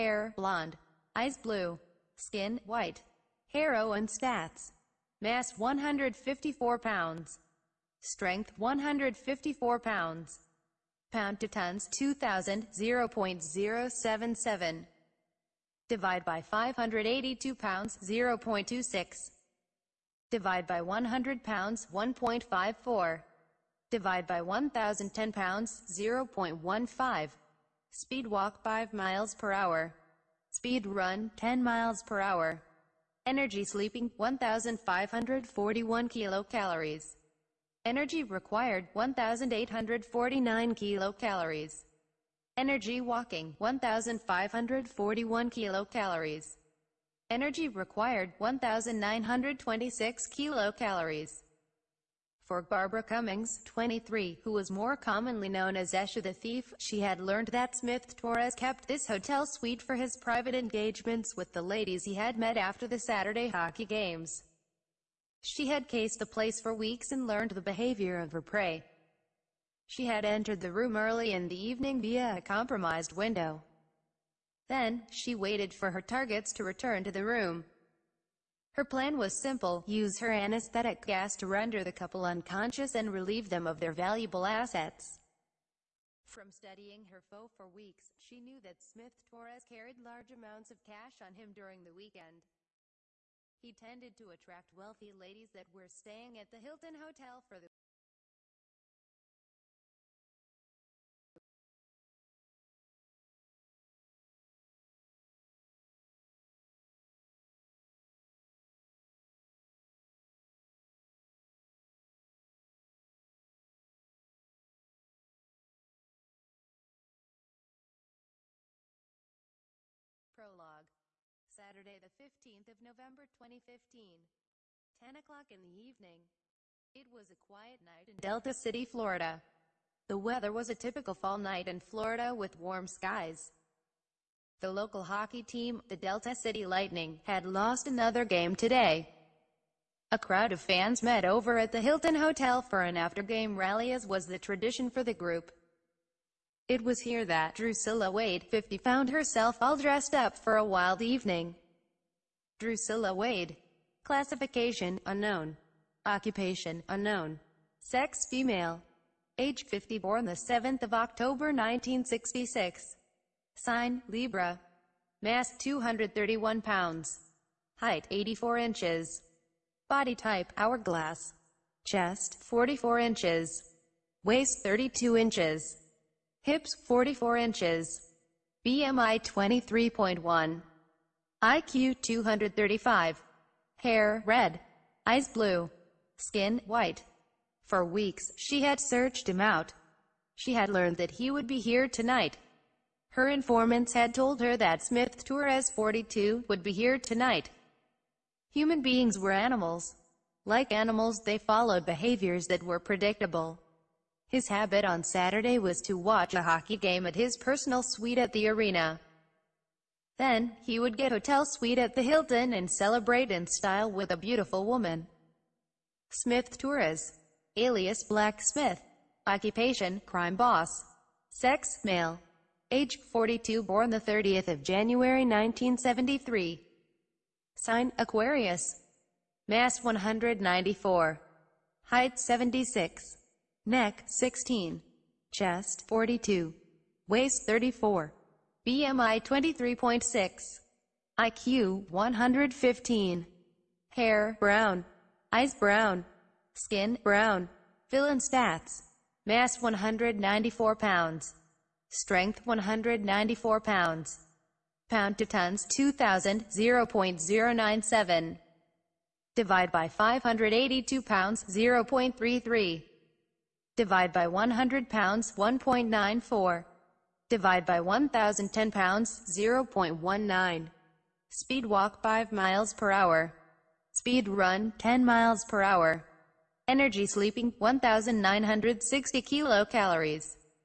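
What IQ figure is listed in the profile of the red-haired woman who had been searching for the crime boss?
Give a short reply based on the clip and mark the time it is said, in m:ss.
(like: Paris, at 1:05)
235, at 3:01.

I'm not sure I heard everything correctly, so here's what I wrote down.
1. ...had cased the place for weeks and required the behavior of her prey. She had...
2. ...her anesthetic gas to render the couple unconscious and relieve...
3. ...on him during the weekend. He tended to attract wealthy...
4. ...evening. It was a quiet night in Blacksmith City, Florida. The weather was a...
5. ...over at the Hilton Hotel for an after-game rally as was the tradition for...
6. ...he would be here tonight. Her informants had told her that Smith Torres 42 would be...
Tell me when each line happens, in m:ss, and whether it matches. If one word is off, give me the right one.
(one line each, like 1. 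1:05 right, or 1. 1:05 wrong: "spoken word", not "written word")
1. 1:05 wrong: "learned", not "required"
2. 1:20 right
3. 1:31 right
4. 2:05 wrong: "Delta", not "Blacksmith"
5. 2:21 right
6. 3:11 right.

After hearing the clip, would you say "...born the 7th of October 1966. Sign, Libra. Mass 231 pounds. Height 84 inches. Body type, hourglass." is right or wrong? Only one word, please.
right.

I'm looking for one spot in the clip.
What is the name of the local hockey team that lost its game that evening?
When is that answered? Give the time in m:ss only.
2:15.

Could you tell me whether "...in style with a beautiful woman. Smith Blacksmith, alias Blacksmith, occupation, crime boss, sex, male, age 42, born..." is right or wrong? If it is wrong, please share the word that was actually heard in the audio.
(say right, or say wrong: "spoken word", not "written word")
wrong: "Torres", not "Blacksmith".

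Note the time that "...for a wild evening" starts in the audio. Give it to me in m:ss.
2:30.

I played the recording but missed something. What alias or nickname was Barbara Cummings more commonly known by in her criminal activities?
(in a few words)
Esha the Thief.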